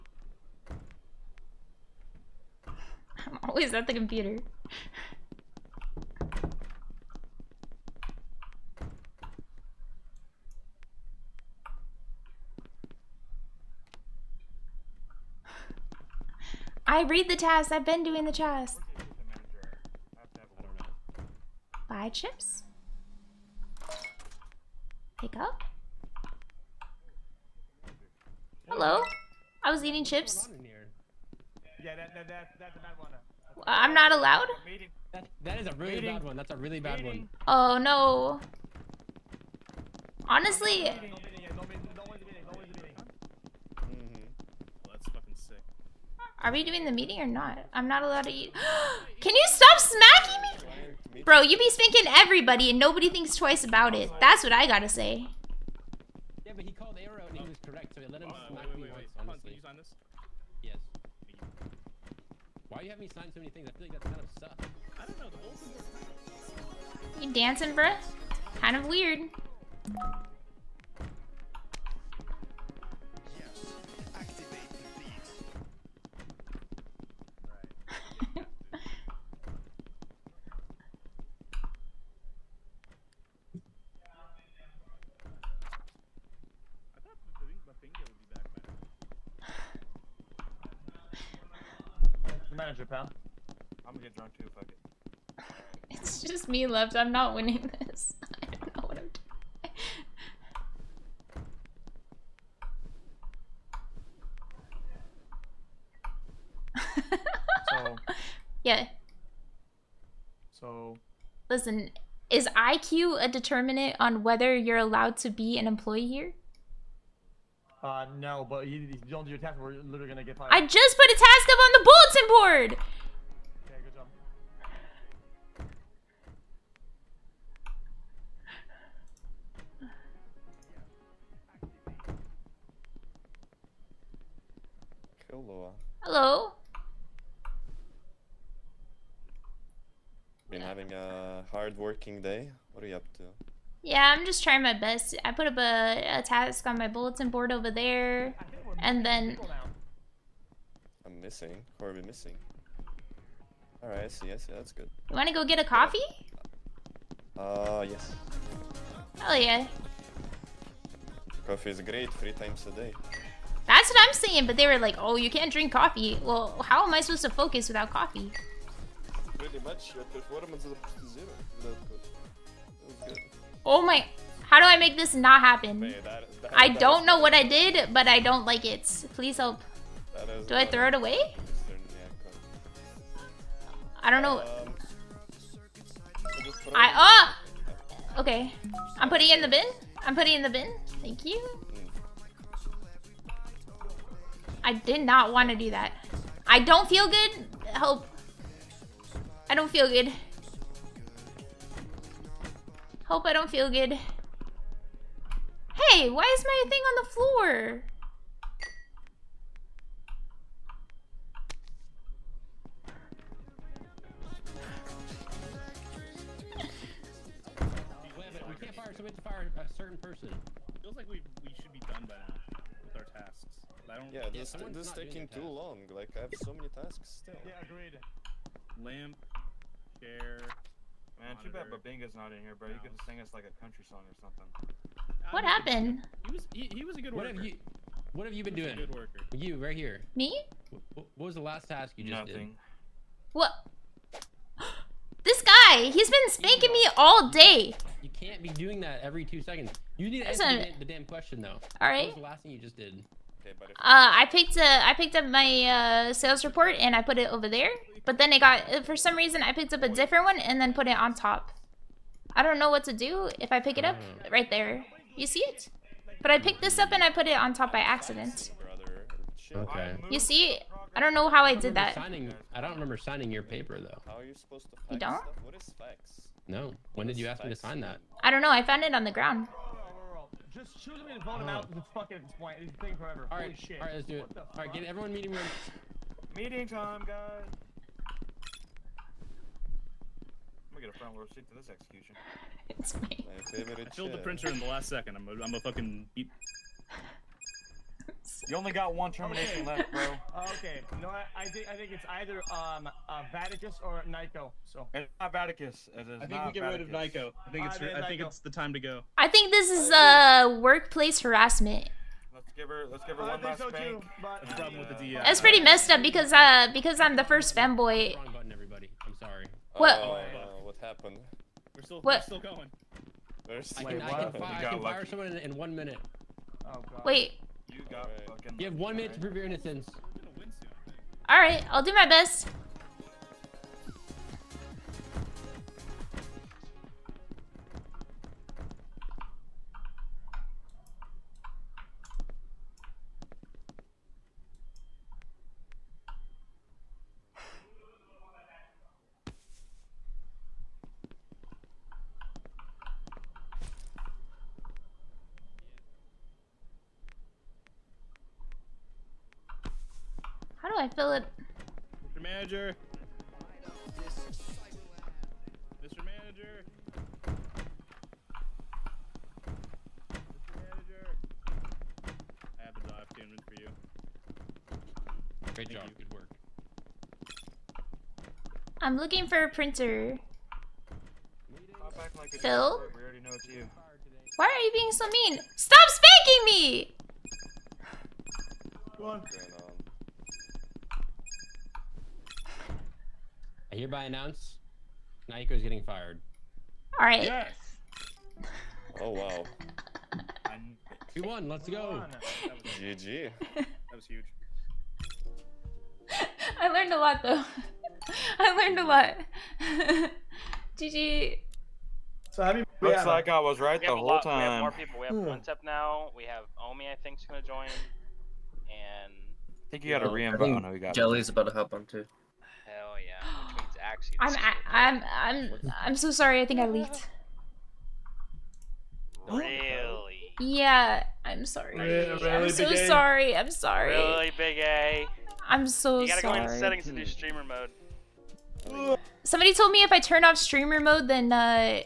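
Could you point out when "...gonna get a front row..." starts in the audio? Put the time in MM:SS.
04:50.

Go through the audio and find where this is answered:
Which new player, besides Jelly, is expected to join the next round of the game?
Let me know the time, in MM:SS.
06:56.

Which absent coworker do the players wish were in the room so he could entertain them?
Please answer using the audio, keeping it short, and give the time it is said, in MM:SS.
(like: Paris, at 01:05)
Babinga, at 03:51.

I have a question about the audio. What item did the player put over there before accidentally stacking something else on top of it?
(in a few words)
sales report.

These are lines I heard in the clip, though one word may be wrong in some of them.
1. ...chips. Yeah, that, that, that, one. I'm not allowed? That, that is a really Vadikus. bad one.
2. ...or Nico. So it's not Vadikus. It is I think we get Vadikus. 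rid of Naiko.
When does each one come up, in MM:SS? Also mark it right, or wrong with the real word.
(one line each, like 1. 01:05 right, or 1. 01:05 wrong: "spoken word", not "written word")
1. 00:30 wrong: "Meeting", not "Vadikus"
2. 05:03 wrong: "Nico", not "Naiko".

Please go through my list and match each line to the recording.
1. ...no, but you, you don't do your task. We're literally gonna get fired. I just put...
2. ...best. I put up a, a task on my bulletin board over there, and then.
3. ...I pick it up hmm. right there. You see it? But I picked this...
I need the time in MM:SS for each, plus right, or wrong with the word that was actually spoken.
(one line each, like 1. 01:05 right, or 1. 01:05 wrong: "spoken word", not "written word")
1. 01:58 right
2. 02:24 right
3. 04:23 right.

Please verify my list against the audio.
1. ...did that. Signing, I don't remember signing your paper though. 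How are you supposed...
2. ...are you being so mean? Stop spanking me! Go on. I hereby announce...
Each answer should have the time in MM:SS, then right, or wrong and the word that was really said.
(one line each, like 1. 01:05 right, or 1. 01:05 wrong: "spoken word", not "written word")
1. 04:31 right
2. 06:24 right.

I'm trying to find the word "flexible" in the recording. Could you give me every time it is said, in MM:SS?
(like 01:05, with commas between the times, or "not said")
not said.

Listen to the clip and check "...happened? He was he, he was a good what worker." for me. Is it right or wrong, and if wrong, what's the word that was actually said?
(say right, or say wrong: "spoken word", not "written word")
right.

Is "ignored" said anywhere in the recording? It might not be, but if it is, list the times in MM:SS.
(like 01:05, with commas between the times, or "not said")
not said.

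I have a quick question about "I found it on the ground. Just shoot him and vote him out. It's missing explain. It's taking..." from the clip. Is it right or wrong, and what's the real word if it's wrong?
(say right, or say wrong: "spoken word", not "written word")
wrong: "fucking", not "missing".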